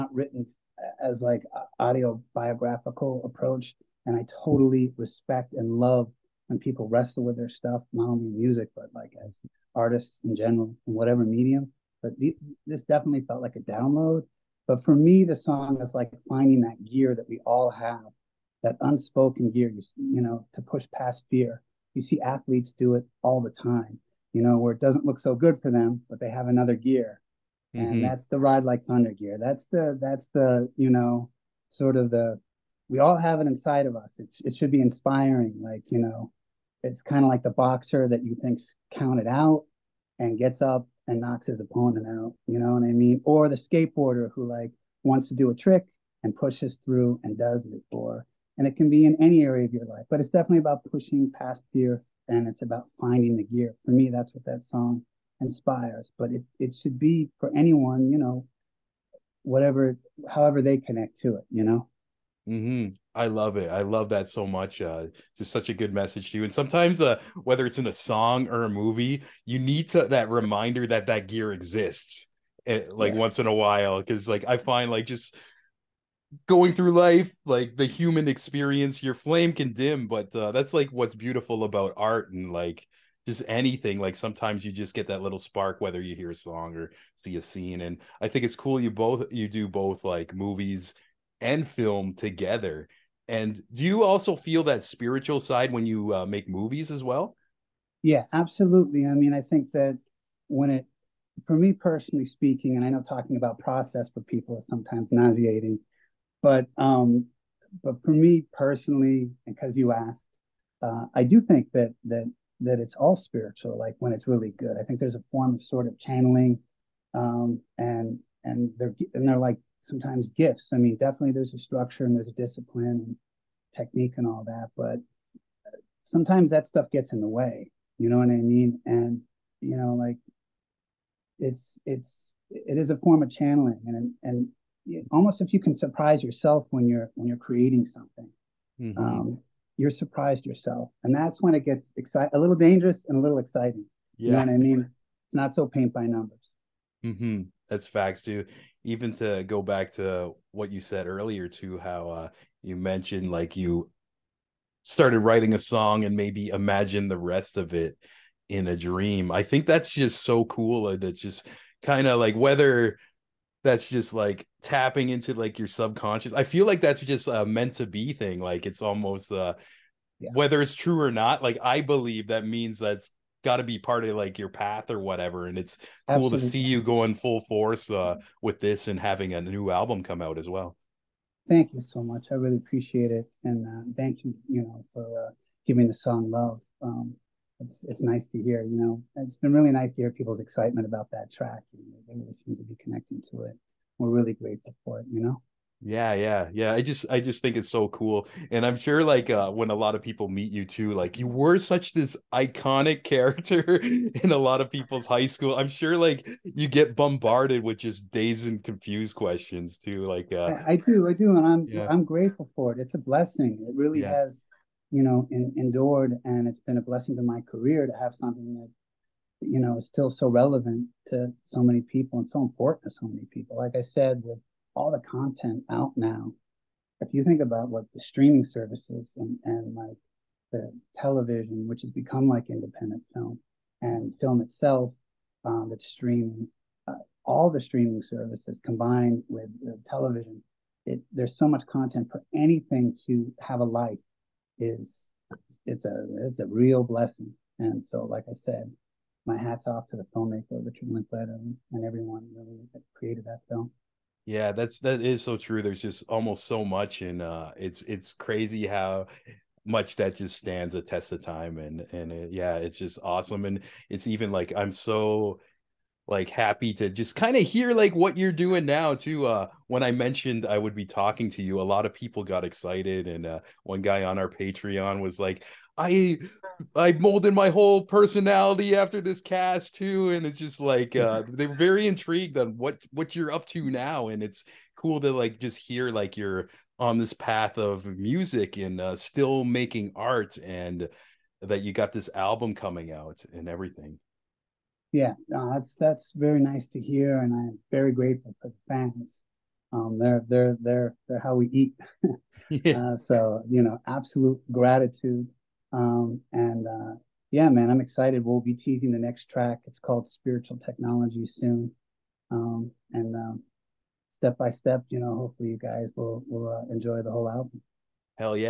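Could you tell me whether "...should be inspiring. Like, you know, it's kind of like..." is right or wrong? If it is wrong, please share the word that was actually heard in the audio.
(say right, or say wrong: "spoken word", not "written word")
right.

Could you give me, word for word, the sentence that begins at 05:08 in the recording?
We'll be teasing the next track.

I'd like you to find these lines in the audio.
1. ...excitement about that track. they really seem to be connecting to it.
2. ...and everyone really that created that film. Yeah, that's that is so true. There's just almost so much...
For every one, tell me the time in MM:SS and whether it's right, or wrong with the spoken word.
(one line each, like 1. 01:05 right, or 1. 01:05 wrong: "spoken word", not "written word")
1. 03:10 right
2. 04:11 right.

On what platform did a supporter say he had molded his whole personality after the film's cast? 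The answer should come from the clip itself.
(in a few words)
Patreon.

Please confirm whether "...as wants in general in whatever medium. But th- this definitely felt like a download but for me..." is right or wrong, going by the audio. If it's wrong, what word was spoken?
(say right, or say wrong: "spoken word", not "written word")
wrong: "artists", not "wants".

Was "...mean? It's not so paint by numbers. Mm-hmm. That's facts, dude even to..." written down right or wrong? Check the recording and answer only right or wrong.
right.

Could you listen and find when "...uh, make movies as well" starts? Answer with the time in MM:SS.
01:36.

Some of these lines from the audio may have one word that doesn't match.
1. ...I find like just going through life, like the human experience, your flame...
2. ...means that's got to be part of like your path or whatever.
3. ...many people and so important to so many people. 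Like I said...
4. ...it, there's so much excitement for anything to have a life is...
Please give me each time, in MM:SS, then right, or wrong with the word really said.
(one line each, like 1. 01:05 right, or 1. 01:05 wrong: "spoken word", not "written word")
1. 01:14 right
2. 02:52 right
3. 03:41 right
4. 04:00 wrong: "content", not "excitement".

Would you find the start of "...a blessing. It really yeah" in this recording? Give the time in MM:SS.
03:32.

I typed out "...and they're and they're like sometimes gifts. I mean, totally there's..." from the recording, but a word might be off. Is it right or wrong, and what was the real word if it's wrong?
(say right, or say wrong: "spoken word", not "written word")
wrong: "definitely", not "totally".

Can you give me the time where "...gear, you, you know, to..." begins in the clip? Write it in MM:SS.
00:19.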